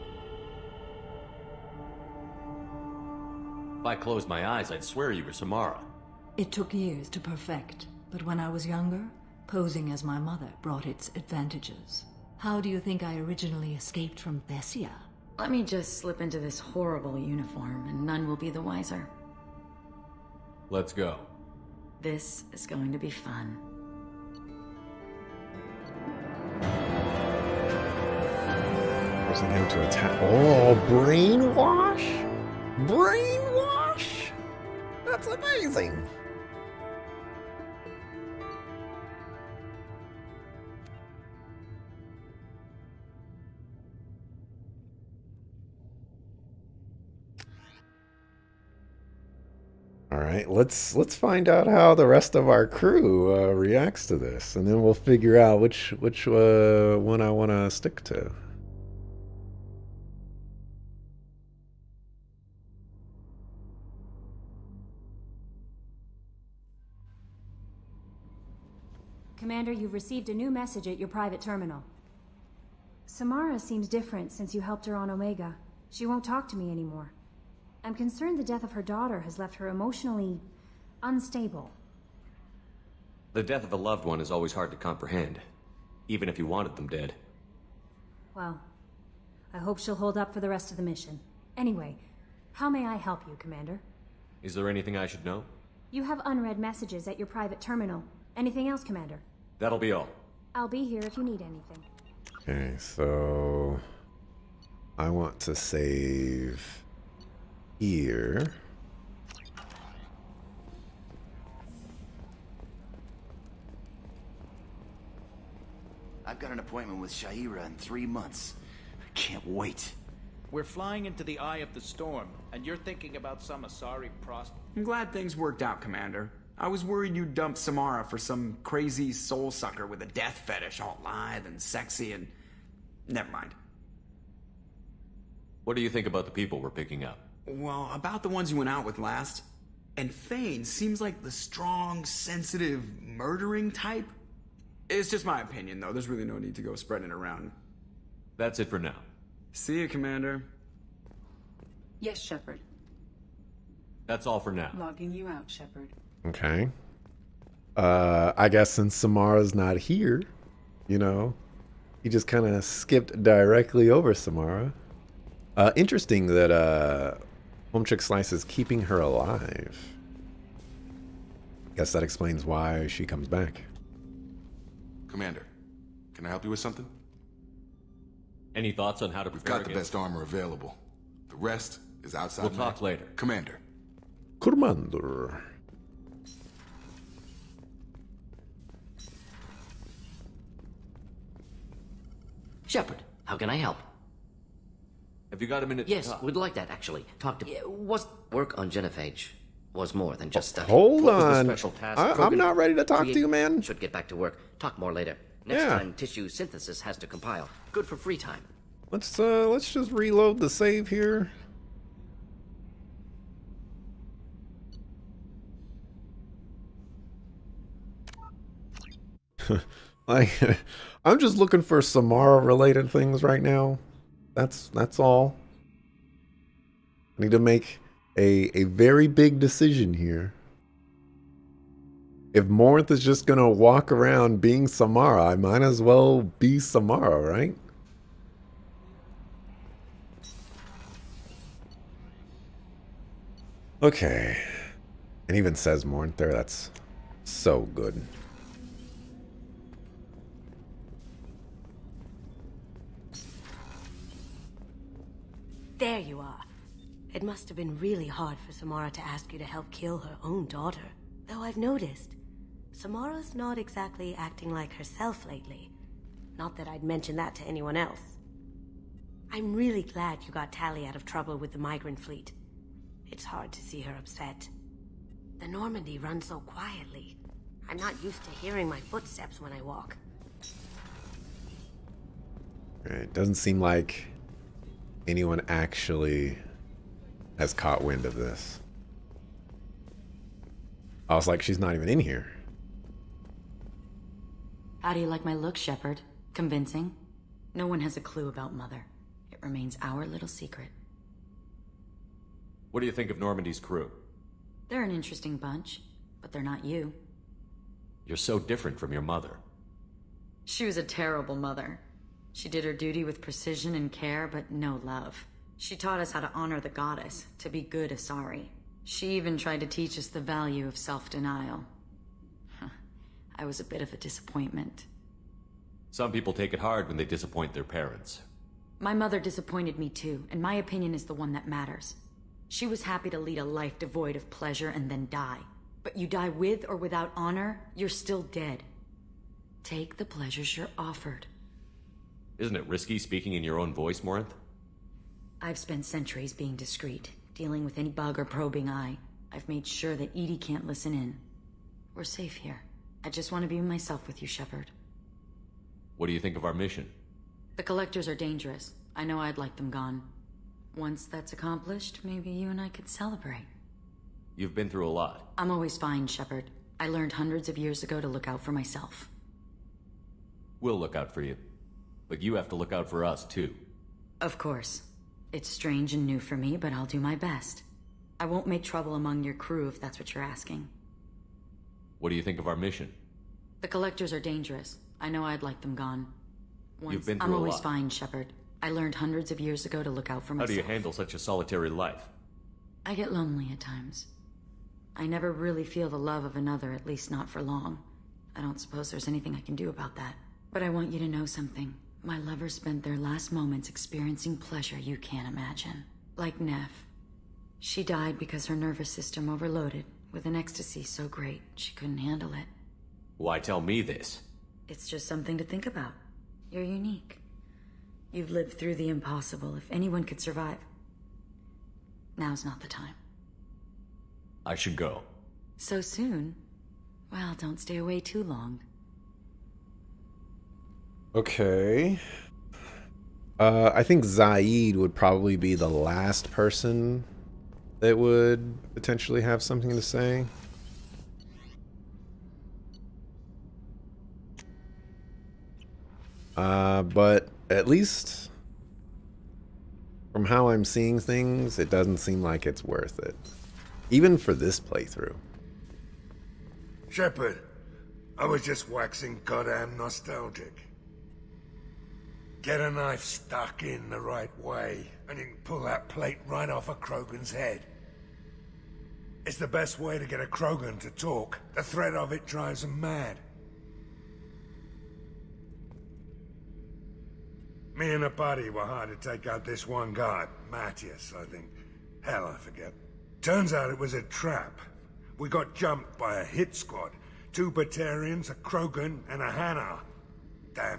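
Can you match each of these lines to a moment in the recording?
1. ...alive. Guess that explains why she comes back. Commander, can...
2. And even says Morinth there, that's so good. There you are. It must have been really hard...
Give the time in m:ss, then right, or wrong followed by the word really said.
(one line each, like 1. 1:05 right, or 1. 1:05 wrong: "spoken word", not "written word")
1. 2:49 right
2. 4:05 right.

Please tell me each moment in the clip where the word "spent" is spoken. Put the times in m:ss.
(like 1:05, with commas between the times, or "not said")
5:45, 6:42.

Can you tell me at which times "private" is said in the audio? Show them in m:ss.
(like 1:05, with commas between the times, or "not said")
1:11, 1:37.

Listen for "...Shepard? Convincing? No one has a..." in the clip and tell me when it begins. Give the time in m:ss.
4:55.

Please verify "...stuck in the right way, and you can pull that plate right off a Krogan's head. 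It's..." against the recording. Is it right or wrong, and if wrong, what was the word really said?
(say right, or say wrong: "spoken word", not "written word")
right.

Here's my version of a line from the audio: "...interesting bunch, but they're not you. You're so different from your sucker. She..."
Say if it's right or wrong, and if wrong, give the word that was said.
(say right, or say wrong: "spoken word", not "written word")
wrong: "mother", not "sucker".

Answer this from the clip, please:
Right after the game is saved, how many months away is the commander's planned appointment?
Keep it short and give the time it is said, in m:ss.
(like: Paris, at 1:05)
3, at 1:57.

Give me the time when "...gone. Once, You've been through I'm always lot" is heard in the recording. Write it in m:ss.
6:25.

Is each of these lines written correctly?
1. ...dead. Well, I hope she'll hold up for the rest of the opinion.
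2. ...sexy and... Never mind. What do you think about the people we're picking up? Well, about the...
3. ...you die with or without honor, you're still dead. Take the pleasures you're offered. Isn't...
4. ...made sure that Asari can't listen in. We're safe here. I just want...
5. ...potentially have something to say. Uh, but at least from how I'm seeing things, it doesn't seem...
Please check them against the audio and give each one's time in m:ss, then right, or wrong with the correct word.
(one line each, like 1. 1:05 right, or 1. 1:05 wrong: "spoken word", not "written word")
1. 1:26 wrong: "mission", not "opinion"
2. 2:11 right
3. 5:35 right
4. 5:49 wrong: "EDI", not "Asari"
5. 7:18 right.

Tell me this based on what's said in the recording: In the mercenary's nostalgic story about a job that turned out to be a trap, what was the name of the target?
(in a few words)
Matthias.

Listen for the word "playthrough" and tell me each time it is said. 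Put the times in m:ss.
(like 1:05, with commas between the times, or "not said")
7:34.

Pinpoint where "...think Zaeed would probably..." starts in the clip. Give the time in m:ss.
7:13.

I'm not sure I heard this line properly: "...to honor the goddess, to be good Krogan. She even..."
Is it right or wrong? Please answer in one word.
wrong.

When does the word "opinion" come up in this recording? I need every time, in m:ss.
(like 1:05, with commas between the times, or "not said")
2:25, 5:30.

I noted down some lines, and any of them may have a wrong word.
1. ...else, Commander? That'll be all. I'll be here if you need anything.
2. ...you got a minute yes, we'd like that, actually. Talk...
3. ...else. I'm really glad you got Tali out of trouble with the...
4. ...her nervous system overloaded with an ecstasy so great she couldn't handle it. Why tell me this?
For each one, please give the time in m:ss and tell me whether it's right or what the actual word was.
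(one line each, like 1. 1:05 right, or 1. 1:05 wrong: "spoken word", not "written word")
1. 1:38 right
2. 3:15 right
3. 4:27 right
4. 6:48 right.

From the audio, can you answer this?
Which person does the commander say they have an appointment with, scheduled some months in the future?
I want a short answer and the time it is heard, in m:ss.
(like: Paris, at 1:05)
Sha'ira, at 1:57.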